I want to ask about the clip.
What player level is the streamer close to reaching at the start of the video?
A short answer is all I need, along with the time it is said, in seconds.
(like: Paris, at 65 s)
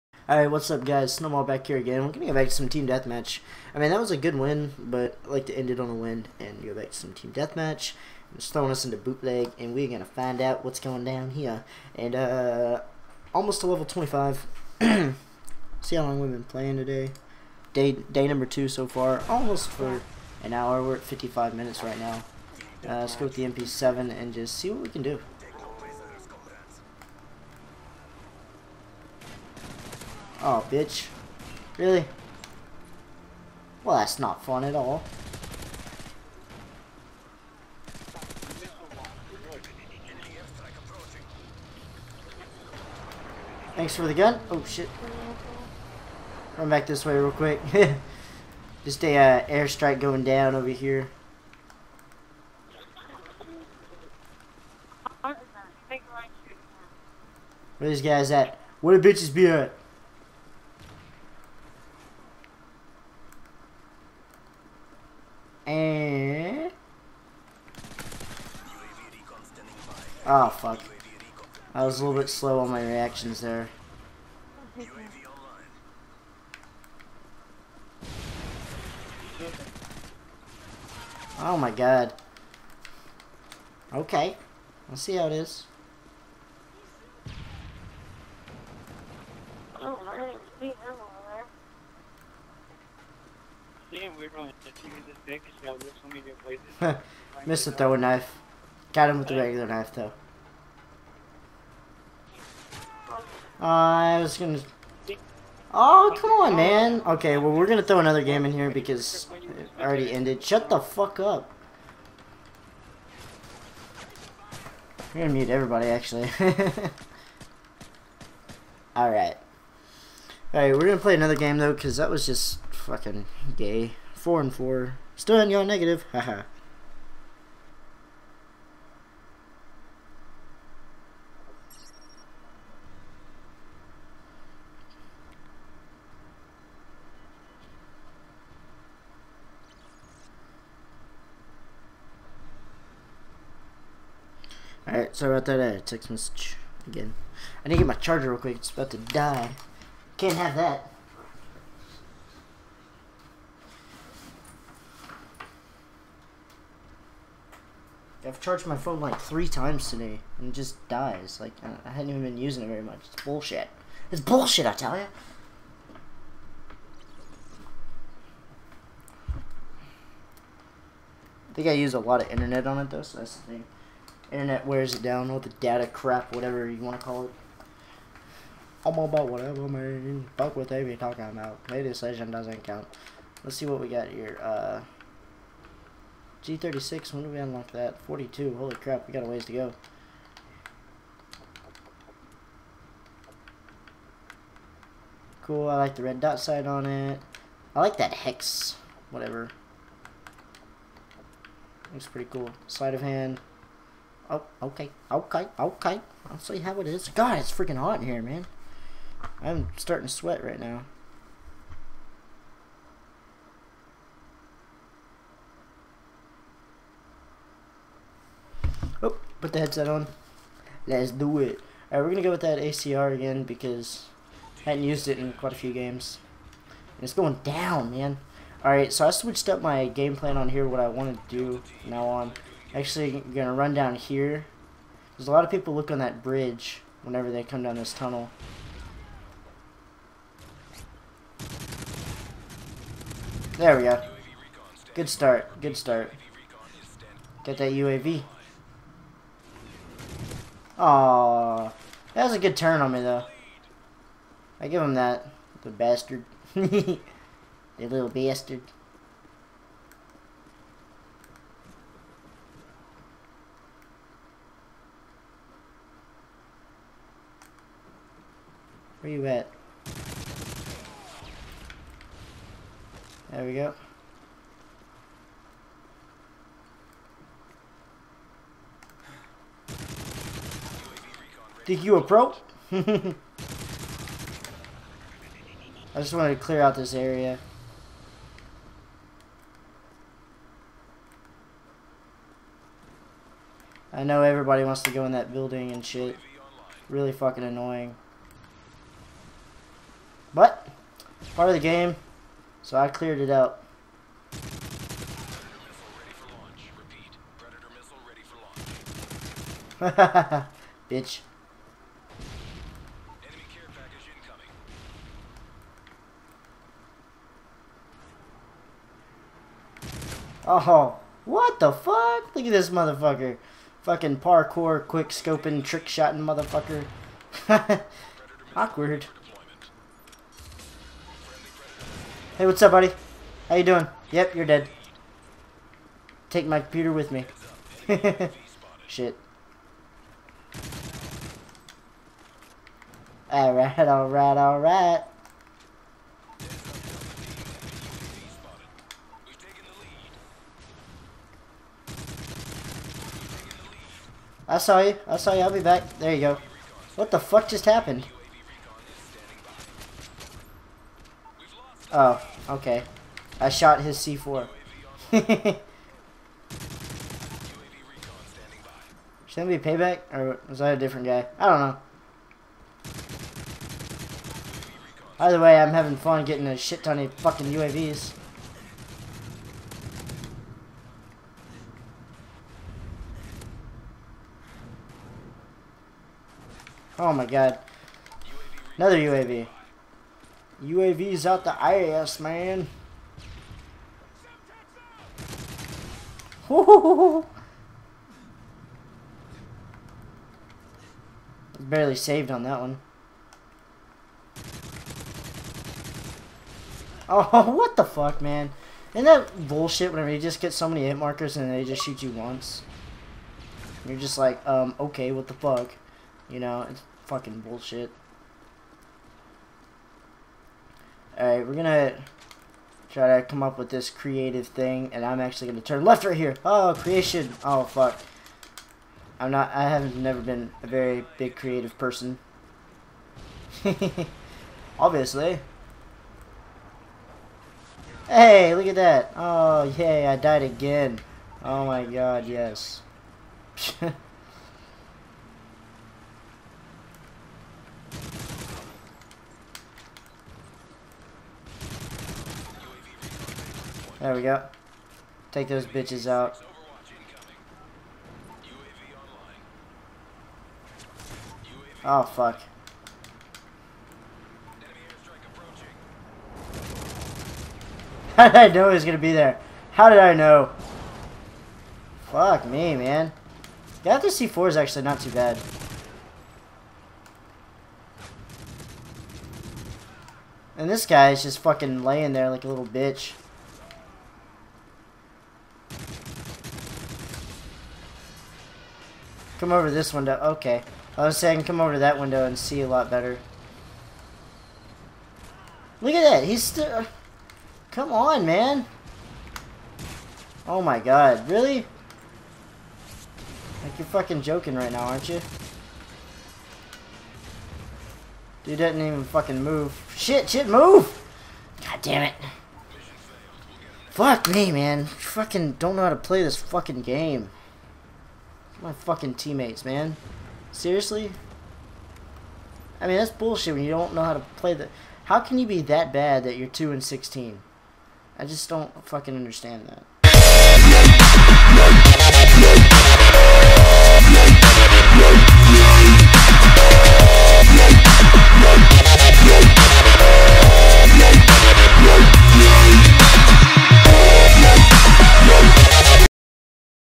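25, at 13 s.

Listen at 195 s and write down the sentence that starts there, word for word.
Cool, I like the red dot sight on it.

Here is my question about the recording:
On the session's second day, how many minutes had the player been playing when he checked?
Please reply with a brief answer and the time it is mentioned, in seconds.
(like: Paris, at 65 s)
55, at 21 s.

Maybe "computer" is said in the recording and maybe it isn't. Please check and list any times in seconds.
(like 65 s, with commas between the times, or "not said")
336 s.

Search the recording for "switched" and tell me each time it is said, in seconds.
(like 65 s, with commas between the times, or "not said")
229 s.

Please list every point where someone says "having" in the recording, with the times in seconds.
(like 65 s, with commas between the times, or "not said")
375 s.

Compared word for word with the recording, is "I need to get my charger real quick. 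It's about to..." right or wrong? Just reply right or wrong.
right.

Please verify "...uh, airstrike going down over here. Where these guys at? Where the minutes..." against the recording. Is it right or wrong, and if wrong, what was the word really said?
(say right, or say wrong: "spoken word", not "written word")
wrong: "bitches", not "minutes".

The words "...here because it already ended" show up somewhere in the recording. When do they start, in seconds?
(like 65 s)
108 s.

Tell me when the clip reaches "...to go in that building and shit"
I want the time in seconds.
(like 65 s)
294 s.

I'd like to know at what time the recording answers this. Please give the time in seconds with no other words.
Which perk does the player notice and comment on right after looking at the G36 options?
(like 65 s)
202 s.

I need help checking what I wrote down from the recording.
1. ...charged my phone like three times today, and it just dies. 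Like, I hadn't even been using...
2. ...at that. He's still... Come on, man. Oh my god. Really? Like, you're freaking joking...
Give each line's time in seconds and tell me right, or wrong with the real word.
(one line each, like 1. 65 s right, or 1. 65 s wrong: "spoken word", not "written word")
1. 158 s right
2. 495 s wrong: "fucking", not "freaking".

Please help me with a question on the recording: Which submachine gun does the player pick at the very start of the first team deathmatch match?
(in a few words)
MP7.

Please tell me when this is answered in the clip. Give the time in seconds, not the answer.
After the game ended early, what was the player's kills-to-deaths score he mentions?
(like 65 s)
124 s.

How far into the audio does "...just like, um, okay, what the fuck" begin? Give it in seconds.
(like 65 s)
413 s.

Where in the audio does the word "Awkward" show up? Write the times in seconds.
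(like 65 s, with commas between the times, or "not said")
328 s.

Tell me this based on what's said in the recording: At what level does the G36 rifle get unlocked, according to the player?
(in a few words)
42.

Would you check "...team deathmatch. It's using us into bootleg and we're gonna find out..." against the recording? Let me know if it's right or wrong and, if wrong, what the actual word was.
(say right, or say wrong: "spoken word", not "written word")
wrong: "throwing", not "using".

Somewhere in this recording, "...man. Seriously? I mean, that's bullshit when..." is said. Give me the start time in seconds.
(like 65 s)
519 s.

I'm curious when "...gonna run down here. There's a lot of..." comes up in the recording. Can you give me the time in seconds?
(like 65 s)
233 s.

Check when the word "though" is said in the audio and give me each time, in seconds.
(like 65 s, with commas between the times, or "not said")
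99 s, 121 s, 172 s, 253 s.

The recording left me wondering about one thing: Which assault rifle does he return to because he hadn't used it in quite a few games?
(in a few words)
ACR.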